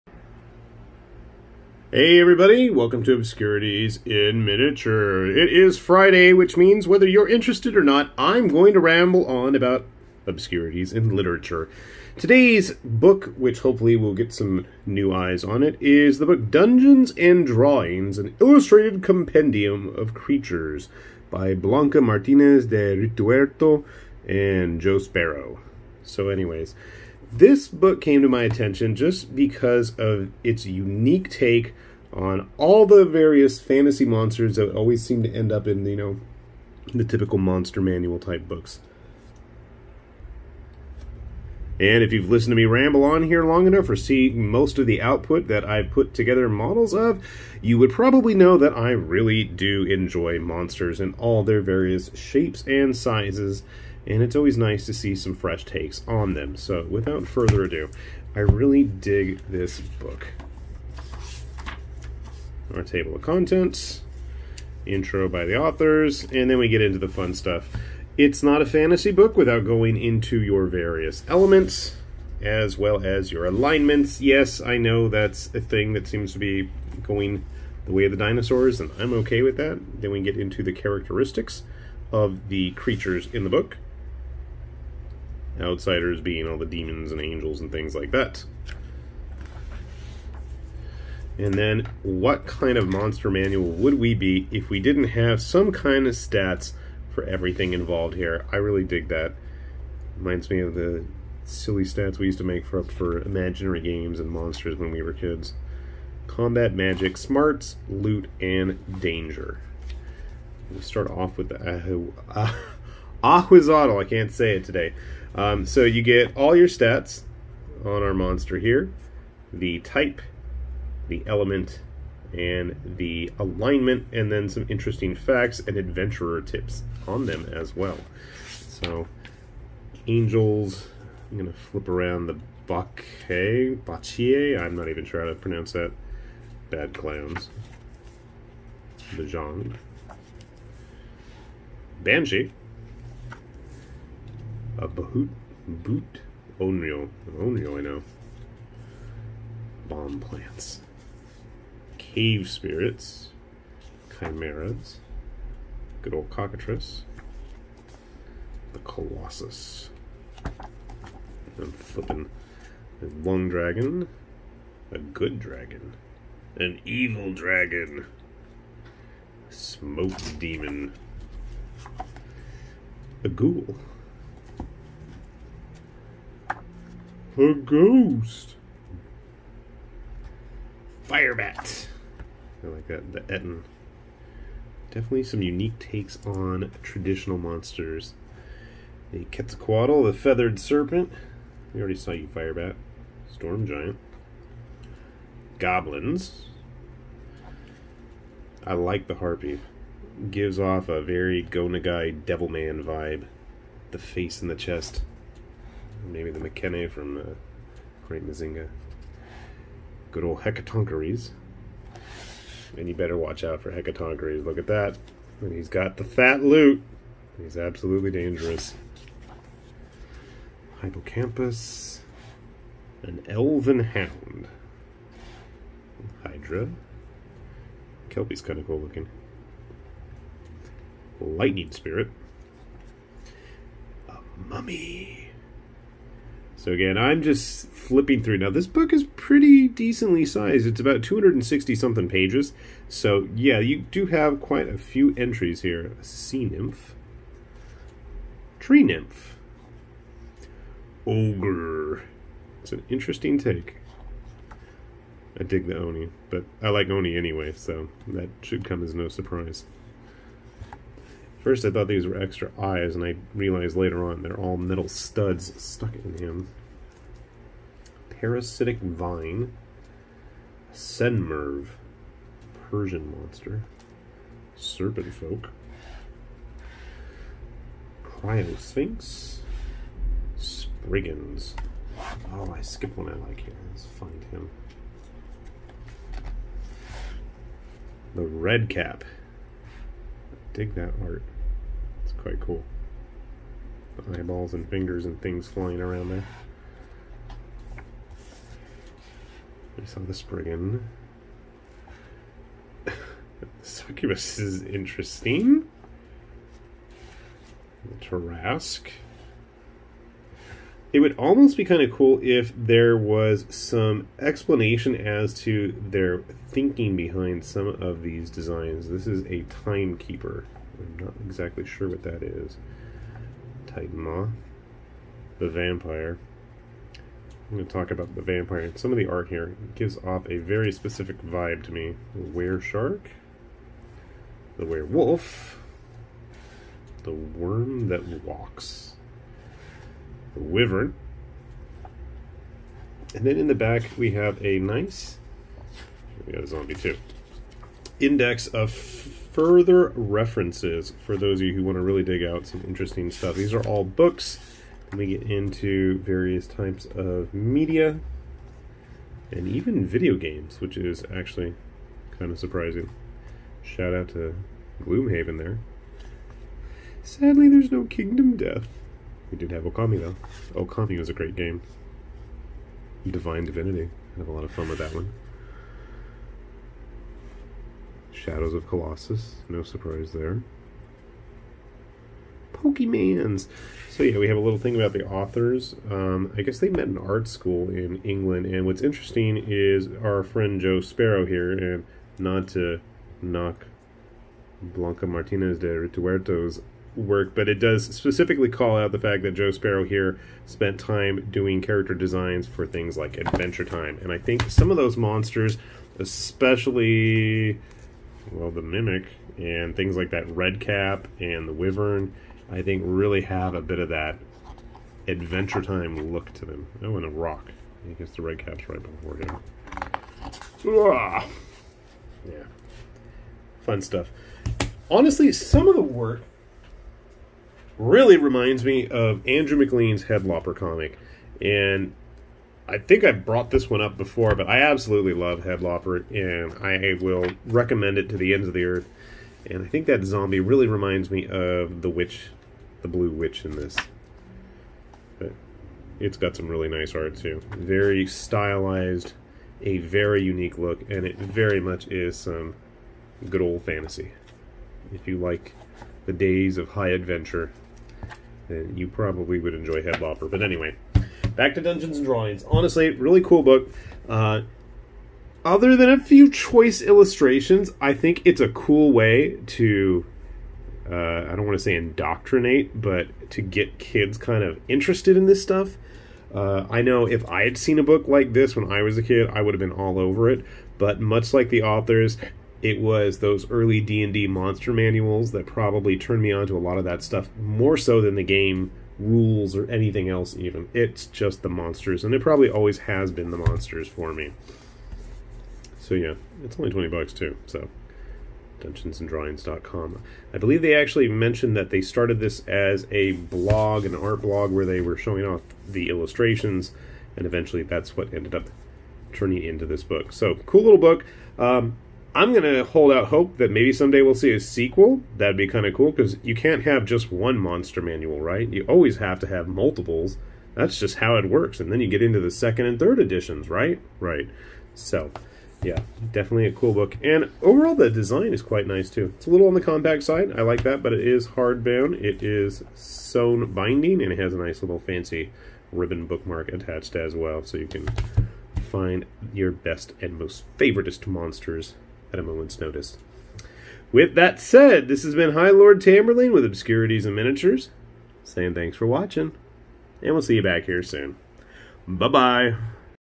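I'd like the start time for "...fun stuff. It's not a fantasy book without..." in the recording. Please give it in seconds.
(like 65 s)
67 s.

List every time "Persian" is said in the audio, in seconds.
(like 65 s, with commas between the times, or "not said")
272 s.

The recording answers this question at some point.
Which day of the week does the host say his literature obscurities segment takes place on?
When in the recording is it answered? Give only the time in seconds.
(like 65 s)
5 s.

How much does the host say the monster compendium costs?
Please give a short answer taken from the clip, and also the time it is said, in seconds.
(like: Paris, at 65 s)
20 bucks, at 496 s.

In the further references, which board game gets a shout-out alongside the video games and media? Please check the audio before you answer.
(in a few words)
Gloomhaven.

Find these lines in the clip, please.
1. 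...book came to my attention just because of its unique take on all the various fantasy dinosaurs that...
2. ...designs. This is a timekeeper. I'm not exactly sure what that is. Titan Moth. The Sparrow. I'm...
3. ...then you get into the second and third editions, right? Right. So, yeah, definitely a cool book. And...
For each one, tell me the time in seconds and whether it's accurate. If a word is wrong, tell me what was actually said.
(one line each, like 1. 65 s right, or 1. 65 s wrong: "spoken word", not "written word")
1. 27 s wrong: "monsters", not "dinosaurs"
2. 318 s wrong: "Vampire", not "Sparrow"
3. 521 s right.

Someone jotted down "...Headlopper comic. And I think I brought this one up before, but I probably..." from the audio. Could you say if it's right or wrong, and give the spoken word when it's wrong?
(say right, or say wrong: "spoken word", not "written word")
wrong: "absolutely", not "probably".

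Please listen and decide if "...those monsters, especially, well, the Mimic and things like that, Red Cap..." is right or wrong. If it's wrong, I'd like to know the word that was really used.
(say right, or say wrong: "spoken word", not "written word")
right.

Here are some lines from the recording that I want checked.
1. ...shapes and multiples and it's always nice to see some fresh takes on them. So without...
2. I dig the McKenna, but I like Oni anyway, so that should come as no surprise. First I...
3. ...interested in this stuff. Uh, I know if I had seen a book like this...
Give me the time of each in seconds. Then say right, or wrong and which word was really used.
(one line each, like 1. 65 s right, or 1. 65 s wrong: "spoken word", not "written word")
1. 52 s wrong: "sizes", not "multiples"
2. 255 s wrong: "Oni", not "McKenna"
3. 474 s right.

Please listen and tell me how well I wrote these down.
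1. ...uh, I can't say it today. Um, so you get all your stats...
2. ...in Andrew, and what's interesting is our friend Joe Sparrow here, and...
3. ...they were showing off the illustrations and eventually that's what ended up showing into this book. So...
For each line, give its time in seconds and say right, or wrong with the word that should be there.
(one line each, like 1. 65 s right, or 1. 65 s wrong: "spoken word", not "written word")
1. 113 s right
2. 387 s wrong: "England", not "Andrew"
3. 504 s wrong: "turning", not "showing".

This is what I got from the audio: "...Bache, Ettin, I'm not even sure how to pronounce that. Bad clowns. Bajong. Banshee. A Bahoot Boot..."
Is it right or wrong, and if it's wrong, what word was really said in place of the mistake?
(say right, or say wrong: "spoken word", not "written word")
wrong: "Bachie", not "Ettin".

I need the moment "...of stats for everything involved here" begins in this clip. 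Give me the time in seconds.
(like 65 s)
96 s.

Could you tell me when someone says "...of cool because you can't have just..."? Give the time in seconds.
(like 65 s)
515 s.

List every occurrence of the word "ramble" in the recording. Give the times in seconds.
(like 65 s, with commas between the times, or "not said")
8 s, 42 s.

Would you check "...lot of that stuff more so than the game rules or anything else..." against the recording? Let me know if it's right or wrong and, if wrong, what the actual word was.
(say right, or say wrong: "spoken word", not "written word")
right.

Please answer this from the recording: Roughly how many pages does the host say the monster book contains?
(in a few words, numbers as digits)
260 something.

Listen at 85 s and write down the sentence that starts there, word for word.
Outsiders being all the demons and angels and things like that.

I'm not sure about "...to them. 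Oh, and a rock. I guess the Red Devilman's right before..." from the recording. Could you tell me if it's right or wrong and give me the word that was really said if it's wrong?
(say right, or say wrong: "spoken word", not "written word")
wrong: "Cap", not "Devilman".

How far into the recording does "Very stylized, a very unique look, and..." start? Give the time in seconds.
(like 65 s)
447 s.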